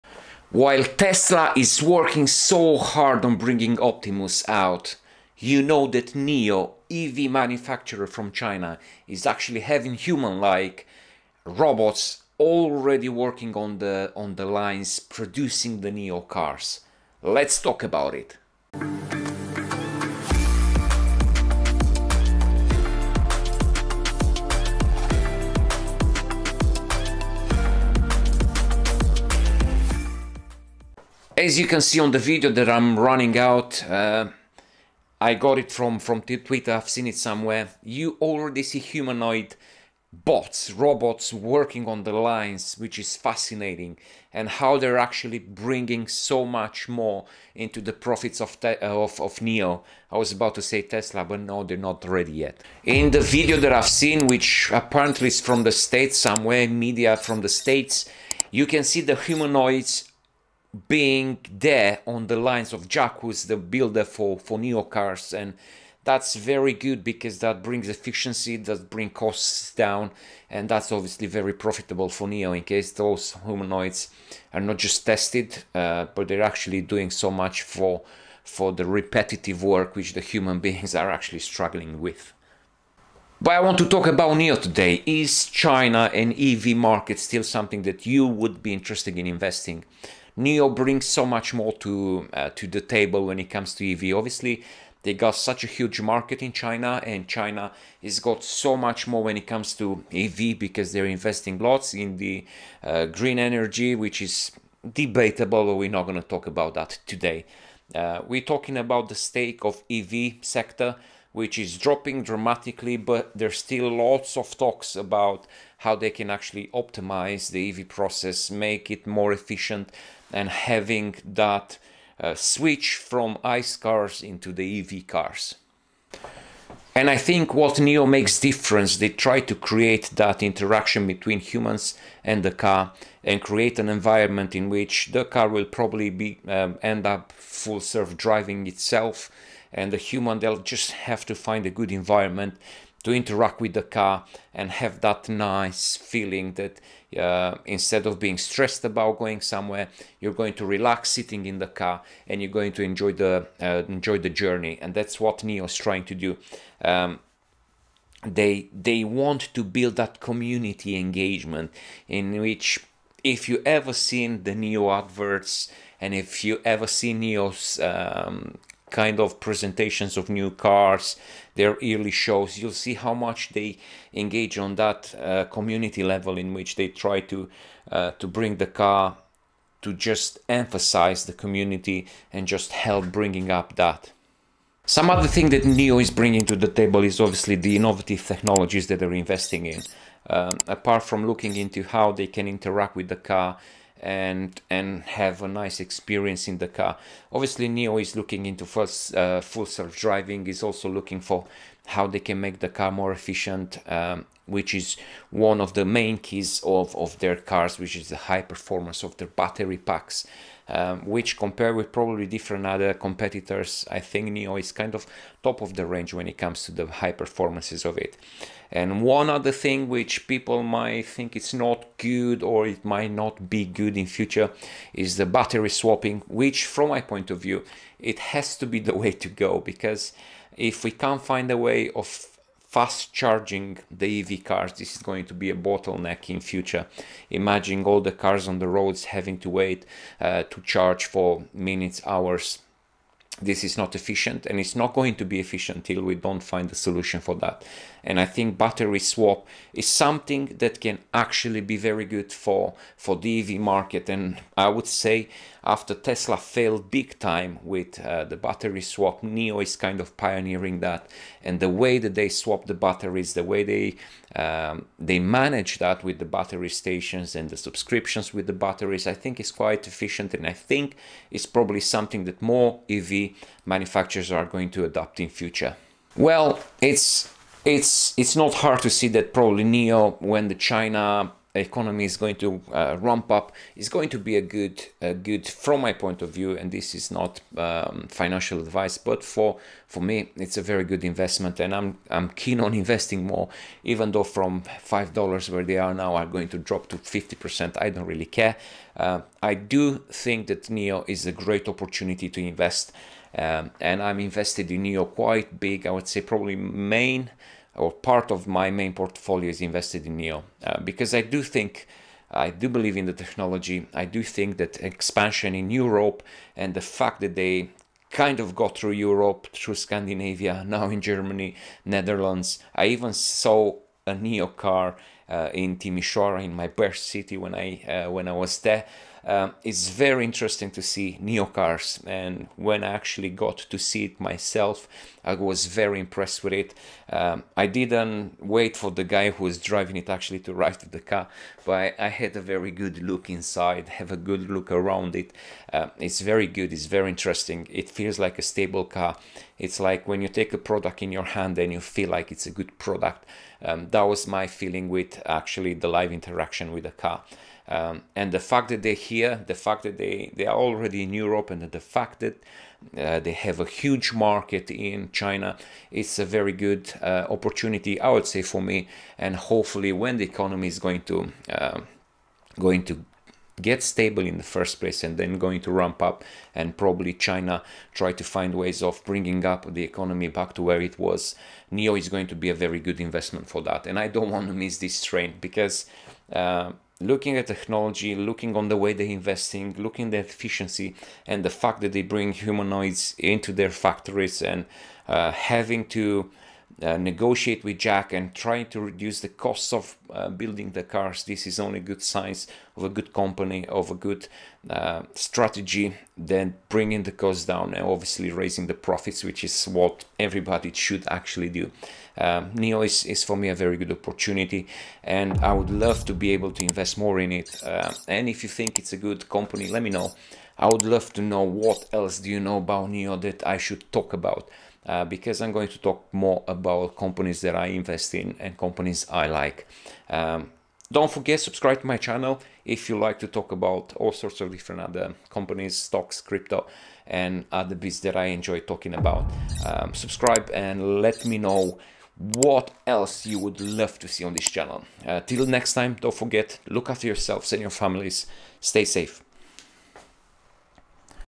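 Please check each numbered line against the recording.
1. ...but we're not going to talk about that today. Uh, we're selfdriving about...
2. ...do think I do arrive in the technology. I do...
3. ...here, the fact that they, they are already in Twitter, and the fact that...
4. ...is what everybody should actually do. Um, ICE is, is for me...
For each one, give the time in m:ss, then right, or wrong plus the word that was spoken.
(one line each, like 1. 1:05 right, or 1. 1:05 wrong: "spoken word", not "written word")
1. 1:45 wrong: "talking", not "selfdriving"
2. 5:11 wrong: "believe", not "arrive"
3. 5:59 wrong: "Europe", not "Twitter"
4. 6:49 wrong: "NIO", not "ICE".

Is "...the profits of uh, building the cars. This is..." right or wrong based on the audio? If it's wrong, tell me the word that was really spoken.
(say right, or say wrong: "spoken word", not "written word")
wrong: "costs", not "profits".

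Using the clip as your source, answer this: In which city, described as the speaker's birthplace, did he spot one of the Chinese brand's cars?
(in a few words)
Timisoara.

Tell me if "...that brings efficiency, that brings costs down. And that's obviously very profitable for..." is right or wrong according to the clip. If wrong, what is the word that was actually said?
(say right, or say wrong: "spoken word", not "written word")
right.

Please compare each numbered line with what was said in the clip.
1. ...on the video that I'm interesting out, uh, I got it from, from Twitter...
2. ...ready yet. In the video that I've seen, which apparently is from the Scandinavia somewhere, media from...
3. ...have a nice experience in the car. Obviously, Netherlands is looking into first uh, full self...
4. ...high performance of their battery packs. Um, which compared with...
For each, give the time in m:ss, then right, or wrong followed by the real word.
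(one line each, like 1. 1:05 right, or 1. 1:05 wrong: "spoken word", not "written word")
1. 0:31 wrong: "running", not "interesting"
2. 0:52 wrong: "States", not "Scandinavia"
3. 3:15 wrong: "NIO", not "Netherlands"
4. 3:28 right.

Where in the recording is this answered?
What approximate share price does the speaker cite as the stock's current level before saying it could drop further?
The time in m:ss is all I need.
4:54.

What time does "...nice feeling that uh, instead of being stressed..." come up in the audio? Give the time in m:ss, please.
2:25.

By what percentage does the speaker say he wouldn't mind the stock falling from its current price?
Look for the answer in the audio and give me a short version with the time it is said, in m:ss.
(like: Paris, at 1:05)
50%, at 4:56.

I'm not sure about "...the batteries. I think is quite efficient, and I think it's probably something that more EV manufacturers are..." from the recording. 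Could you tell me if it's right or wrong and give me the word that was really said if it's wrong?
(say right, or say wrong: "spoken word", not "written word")
right.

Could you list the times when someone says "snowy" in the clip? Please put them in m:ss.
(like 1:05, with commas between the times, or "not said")
not said.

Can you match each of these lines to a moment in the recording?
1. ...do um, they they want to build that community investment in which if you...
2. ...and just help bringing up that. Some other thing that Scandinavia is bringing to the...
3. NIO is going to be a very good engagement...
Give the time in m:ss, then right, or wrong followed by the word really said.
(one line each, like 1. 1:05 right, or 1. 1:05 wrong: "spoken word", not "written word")
1. 2:36 wrong: "engagement", not "investment"
2. 3:02 wrong: "NIO", not "Scandinavia"
3. 6:21 wrong: "investment", not "engagement".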